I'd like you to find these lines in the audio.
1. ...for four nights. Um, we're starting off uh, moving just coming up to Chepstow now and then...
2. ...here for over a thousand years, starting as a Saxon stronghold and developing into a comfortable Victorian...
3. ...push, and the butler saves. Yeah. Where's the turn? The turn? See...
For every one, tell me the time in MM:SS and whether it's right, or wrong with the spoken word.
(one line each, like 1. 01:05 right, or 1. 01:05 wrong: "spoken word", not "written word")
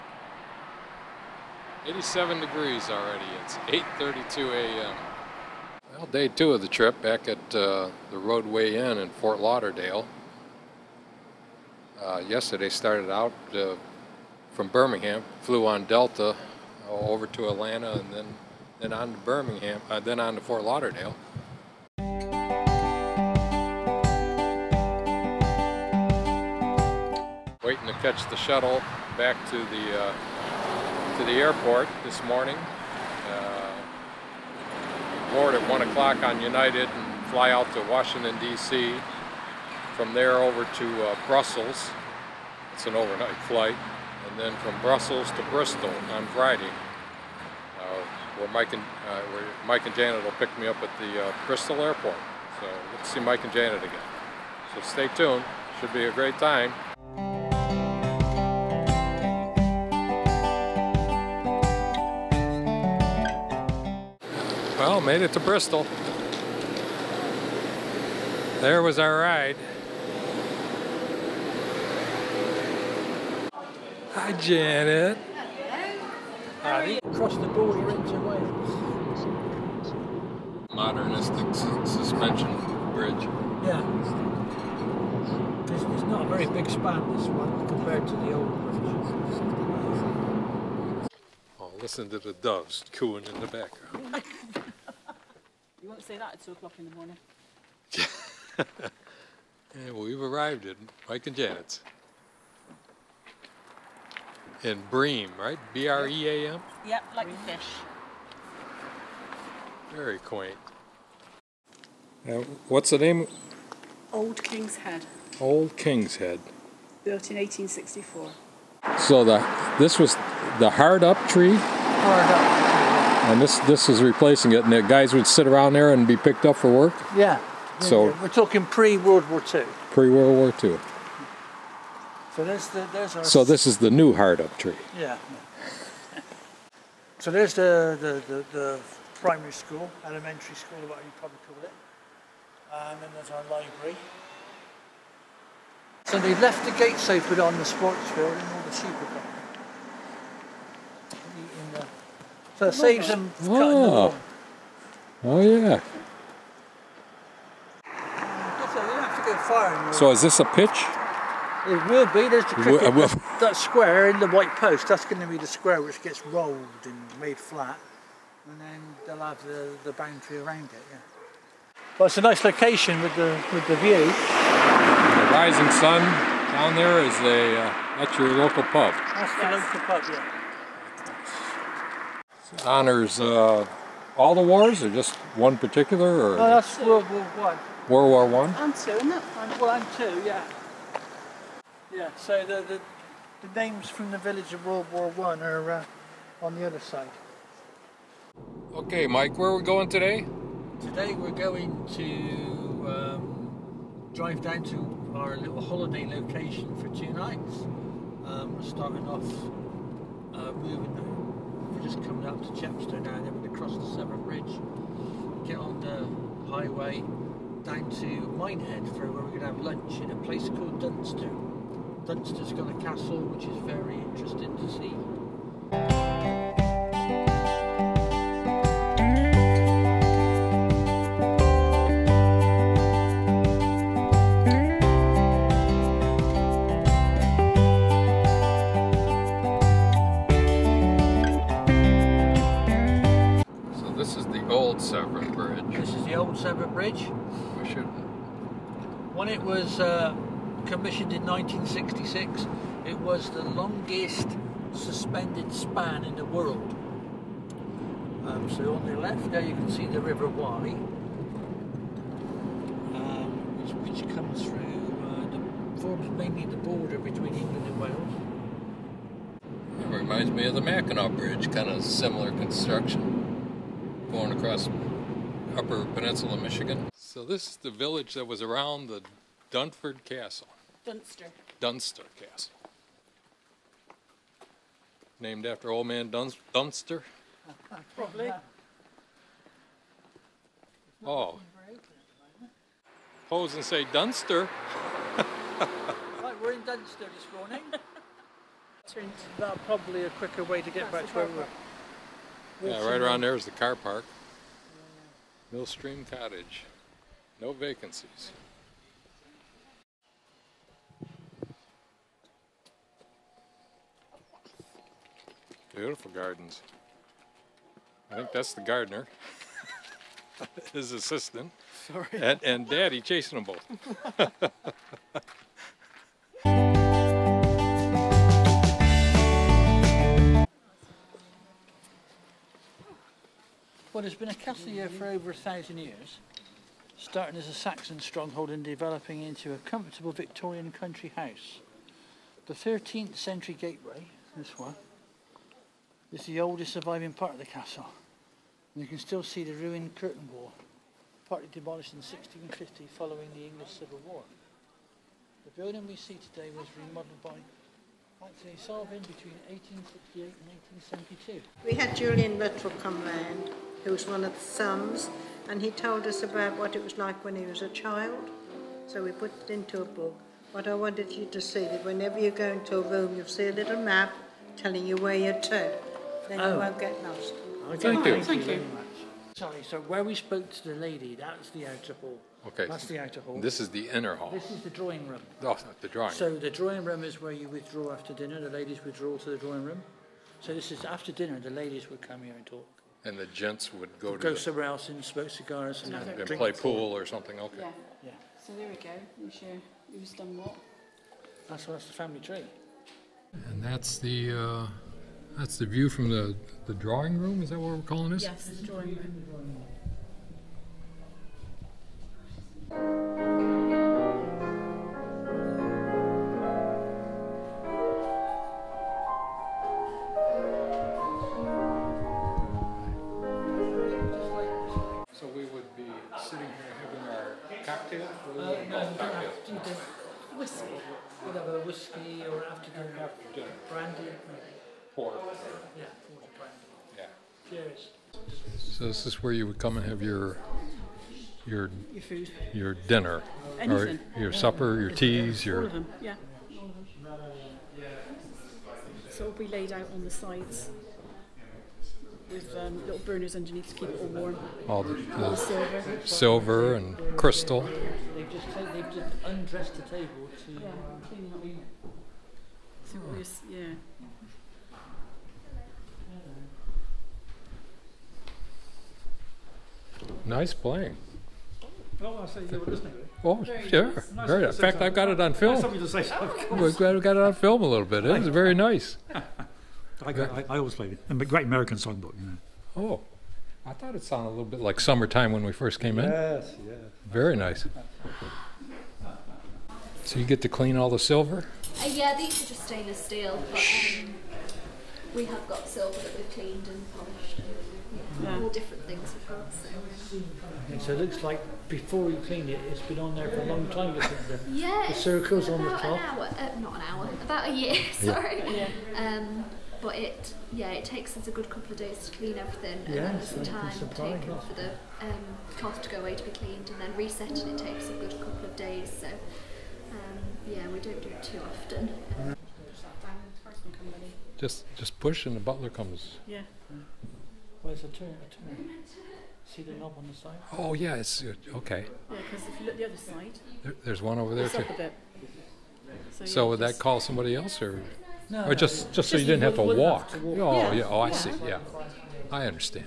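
1. 03:26 wrong: "two", not "four"
2. 05:34 right
3. 08:45 wrong: "comes", not "saves".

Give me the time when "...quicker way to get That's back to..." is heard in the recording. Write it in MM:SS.
05:00.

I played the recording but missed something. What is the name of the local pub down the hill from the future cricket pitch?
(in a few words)
The Rising Sun.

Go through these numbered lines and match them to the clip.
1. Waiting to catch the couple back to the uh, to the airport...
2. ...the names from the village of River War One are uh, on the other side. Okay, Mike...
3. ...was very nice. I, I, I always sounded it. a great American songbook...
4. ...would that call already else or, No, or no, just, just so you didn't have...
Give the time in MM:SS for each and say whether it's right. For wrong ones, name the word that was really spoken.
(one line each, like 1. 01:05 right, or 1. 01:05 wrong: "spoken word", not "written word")
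1. 00:27 wrong: "shuttle", not "couple"
2. 03:13 wrong: "World", not "River"
3. 07:58 wrong: "played", not "sounded"
4. 08:56 wrong: "somebody", not "already".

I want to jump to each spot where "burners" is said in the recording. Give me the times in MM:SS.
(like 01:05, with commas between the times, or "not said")
07:32.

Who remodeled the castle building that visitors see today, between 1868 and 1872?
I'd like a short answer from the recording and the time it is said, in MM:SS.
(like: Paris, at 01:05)
Anthony Salvin, at 05:58.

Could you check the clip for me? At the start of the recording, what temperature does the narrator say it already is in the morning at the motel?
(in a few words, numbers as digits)
87 degrees.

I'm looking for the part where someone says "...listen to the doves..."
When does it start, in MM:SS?
01:31.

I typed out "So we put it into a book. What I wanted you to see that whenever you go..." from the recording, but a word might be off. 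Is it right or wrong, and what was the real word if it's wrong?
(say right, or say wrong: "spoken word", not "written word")
right.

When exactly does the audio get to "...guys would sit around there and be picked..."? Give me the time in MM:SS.
02:04.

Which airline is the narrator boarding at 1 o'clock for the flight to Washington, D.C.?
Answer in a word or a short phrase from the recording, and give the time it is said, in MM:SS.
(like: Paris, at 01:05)
United, at 00:36.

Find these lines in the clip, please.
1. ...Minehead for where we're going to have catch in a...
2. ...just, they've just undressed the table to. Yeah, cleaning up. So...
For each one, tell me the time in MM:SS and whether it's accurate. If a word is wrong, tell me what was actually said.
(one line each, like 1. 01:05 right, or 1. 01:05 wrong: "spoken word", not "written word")
1. 03:38 wrong: "lunch", not "catch"
2. 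07:38 right.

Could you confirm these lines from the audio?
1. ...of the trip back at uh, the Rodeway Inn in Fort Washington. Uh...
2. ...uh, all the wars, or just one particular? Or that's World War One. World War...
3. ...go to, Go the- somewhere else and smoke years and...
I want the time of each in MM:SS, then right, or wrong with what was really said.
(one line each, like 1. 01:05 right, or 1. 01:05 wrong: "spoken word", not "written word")
1. 00:06 wrong: "Lauderdale", not "Washington"
2. 03:03 right
3. 06:33 wrong: "cigars", not "years".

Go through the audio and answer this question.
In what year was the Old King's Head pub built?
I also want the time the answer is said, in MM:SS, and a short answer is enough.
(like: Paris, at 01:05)
1864, at 01:57.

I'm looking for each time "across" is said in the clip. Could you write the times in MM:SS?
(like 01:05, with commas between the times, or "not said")
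01:17, 04:34.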